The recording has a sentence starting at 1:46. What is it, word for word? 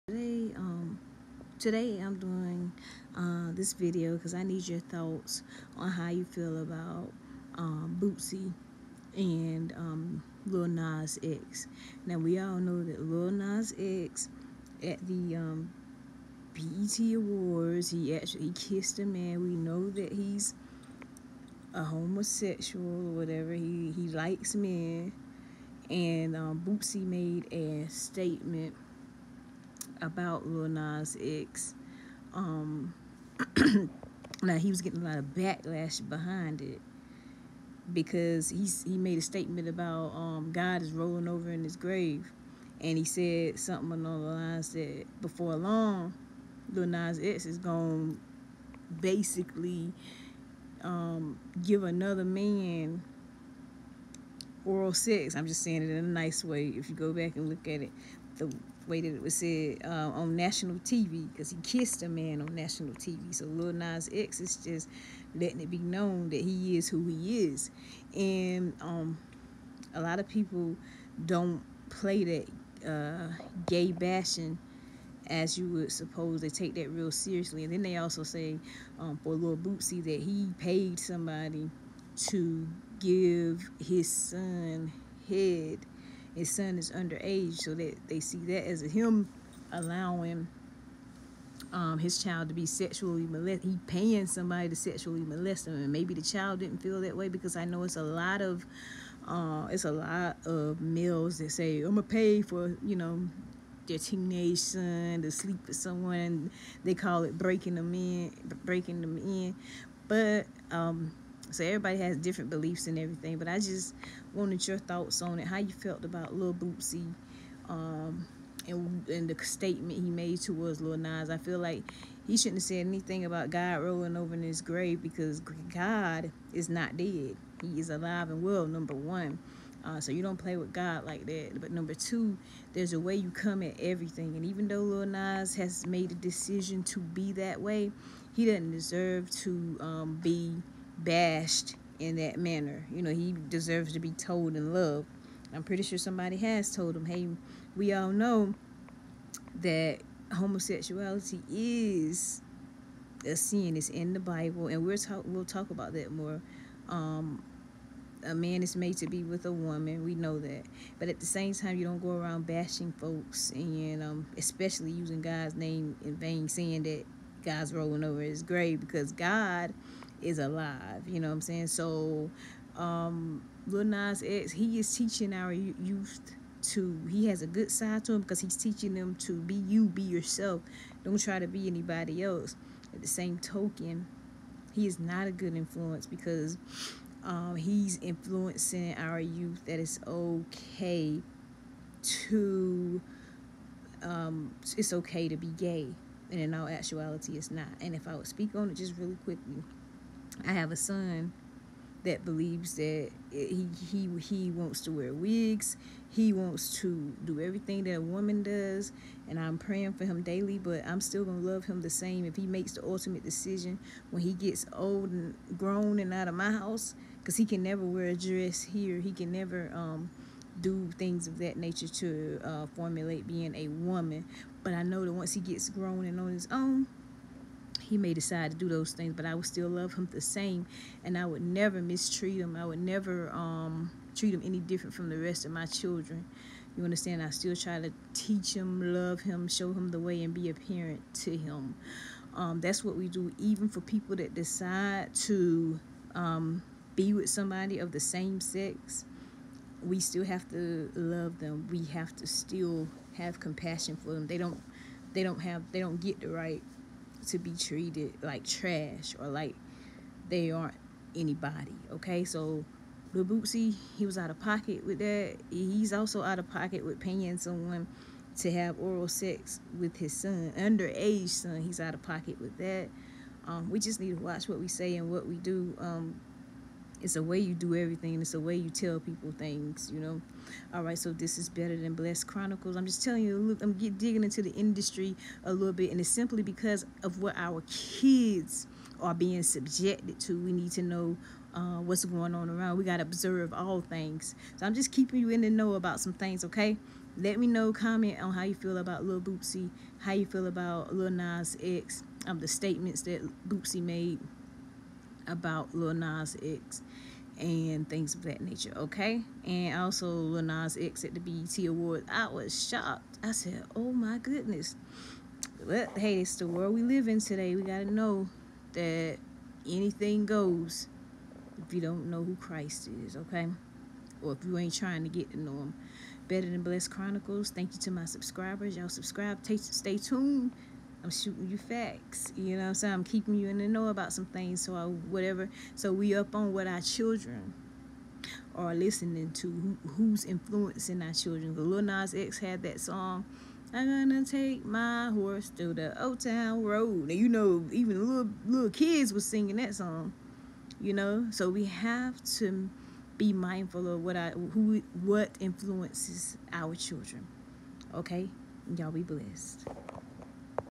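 They call it breaking them in, breaking them in.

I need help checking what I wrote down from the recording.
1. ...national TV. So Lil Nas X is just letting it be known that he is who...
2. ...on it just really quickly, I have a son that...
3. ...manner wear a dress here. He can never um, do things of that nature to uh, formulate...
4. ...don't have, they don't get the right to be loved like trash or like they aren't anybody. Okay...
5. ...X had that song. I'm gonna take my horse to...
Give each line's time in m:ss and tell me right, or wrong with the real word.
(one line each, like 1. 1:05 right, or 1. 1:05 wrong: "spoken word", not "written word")
1. 1:02 right
2. 3:18 right
3. 3:37 wrong: "never", not "manner"
4. 4:15 wrong: "treated", not "loved"
5. 5:42 right.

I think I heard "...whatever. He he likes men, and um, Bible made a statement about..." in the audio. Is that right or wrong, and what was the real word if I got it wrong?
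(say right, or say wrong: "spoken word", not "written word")
wrong: "Boosie", not "Bible".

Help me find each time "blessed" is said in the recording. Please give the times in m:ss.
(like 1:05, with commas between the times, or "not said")
4:41, 5:26, 5:59.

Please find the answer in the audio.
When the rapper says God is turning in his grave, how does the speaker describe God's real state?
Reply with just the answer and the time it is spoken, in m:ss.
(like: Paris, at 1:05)
alive and well, at 2:07.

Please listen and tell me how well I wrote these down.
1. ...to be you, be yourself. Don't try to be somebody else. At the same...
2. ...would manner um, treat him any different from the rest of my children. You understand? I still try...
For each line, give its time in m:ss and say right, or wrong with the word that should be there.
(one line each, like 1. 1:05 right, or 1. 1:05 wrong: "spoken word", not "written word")
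1. 2:59 wrong: "anybody", not "somebody"
2. 3:52 wrong: "never", not "manner".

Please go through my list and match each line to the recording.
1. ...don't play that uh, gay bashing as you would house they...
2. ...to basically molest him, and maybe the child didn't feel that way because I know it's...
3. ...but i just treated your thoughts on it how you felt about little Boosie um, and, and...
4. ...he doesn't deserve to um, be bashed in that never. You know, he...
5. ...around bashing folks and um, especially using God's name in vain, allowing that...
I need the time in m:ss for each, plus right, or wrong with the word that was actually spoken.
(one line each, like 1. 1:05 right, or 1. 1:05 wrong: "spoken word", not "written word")
1. 1:11 wrong: "suppose", not "house"
2. 1:34 wrong: "sexually", not "basically"
3. 1:53 wrong: "wanted", not "treated"
4. 2:18 wrong: "manner", not "never"
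5. 2:42 wrong: "saying", not "allowing".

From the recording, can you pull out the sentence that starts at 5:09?
And also Lil Nas X at the BET Awards, I was shocked.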